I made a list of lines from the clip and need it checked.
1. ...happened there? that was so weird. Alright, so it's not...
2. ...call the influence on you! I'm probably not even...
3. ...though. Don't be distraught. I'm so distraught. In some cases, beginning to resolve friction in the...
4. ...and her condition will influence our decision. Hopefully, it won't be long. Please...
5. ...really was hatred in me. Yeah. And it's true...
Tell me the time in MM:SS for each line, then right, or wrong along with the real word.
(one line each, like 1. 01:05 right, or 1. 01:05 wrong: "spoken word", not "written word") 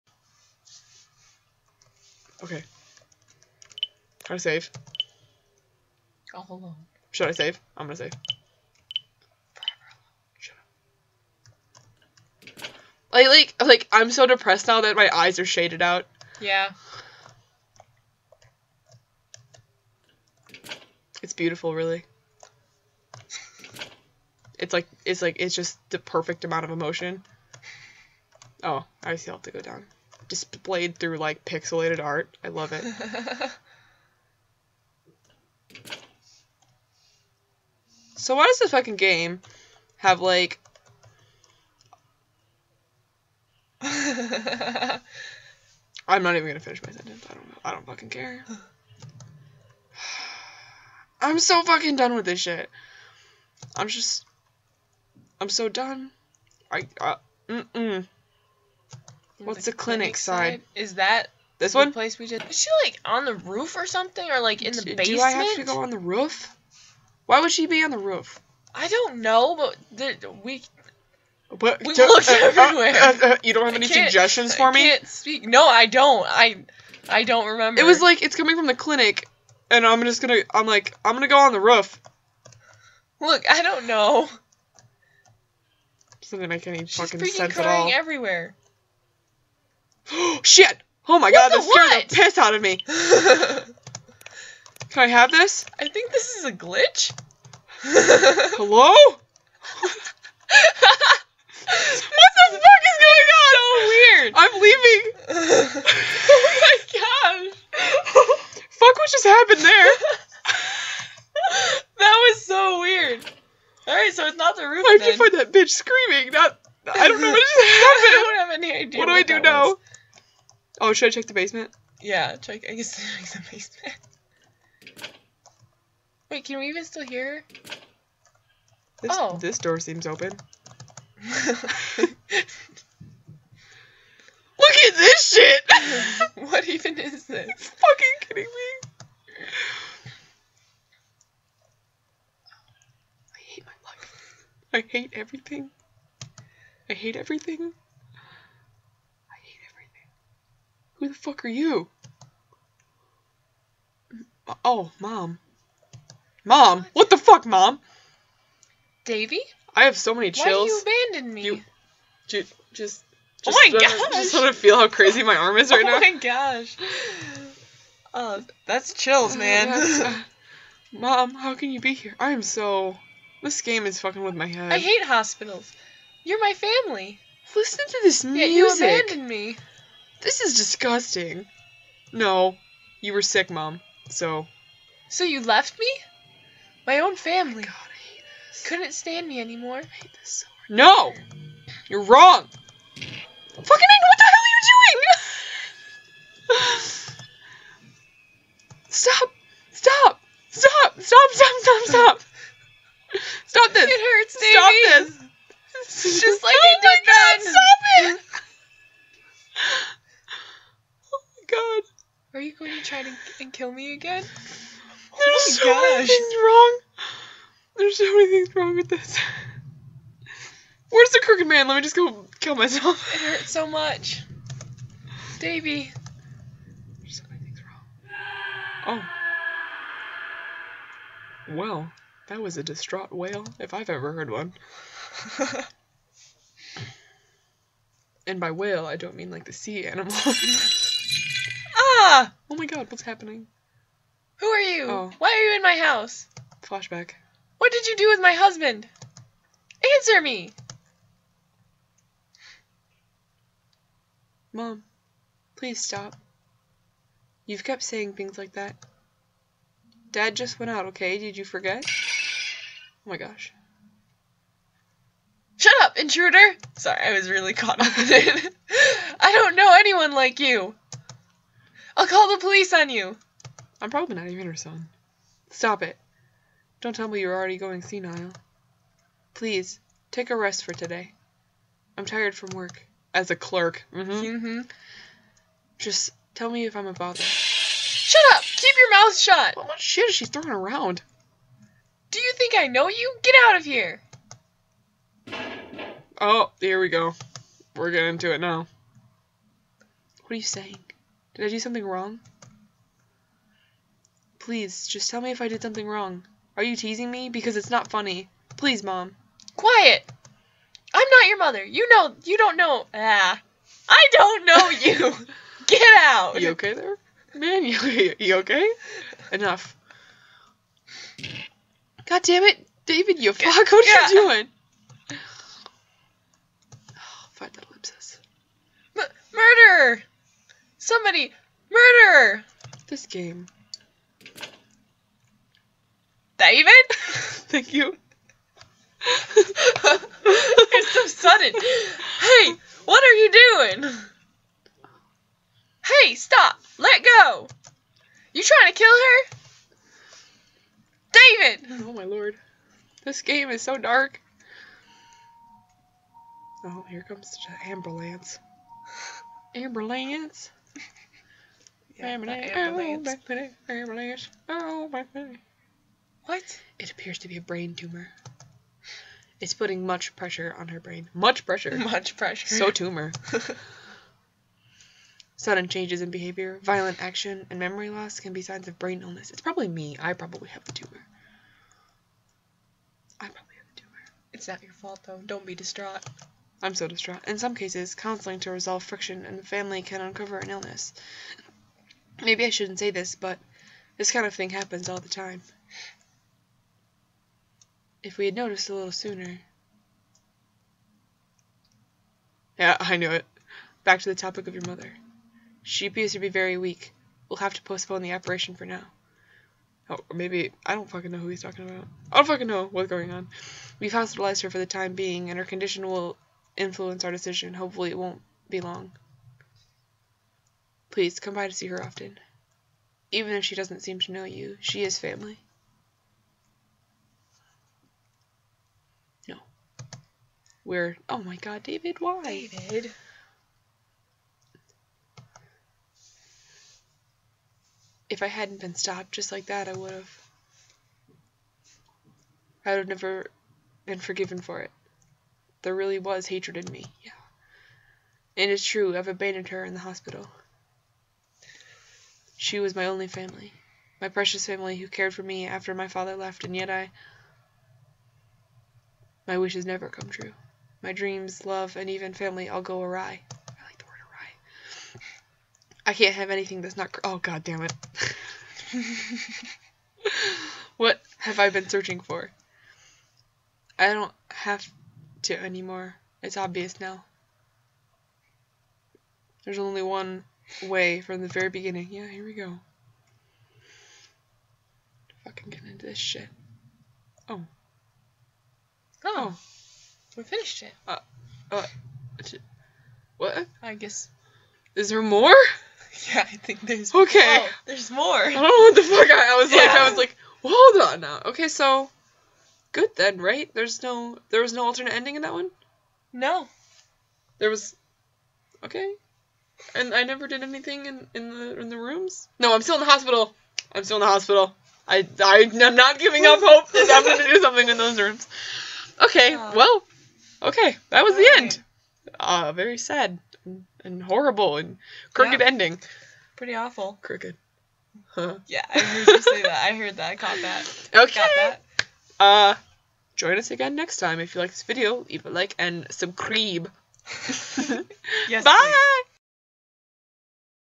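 1. 01:49 right
2. 04:32 wrong: "police", not "influence"
3. 06:25 wrong: "counseling", not "beginning"
4. 06:55 right
5. 07:25 right.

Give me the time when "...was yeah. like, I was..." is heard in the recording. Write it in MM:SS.
08:19.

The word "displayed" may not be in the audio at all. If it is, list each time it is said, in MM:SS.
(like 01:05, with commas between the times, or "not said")
00:30.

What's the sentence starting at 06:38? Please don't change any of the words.
If we had noticed a little sooner.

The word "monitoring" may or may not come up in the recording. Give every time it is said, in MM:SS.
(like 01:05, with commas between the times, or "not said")
not said.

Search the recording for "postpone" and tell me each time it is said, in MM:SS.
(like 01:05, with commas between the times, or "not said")
06:47.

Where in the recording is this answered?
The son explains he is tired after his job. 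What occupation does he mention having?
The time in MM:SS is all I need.
04:43.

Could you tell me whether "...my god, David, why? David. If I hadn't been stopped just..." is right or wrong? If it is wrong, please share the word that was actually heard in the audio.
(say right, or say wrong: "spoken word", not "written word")
right.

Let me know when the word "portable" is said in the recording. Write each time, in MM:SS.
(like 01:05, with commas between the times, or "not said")
not said.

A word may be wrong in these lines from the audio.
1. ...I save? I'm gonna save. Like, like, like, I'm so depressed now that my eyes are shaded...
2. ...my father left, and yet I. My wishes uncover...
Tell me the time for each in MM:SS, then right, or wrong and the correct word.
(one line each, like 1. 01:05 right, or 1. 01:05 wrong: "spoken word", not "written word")
1. 00:07 right
2. 07:35 wrong: "never", not "uncover".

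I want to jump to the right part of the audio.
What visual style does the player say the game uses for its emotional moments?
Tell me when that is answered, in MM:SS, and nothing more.
00:31.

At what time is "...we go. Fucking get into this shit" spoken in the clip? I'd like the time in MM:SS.
08:02.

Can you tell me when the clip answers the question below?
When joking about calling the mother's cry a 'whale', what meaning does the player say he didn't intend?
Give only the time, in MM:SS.
03:59.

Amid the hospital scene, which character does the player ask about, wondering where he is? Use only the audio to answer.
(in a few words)
the crooked man.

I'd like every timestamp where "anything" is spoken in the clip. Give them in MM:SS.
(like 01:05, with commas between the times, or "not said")
07:46, 08:30.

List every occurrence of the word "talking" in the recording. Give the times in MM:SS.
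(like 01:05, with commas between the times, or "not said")
06:51.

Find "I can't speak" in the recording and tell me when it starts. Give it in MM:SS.
01:14.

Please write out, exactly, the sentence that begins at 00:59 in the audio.
What's the, the clinic, clinic side?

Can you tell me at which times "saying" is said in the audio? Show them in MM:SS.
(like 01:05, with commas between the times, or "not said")
04:17, 05:00.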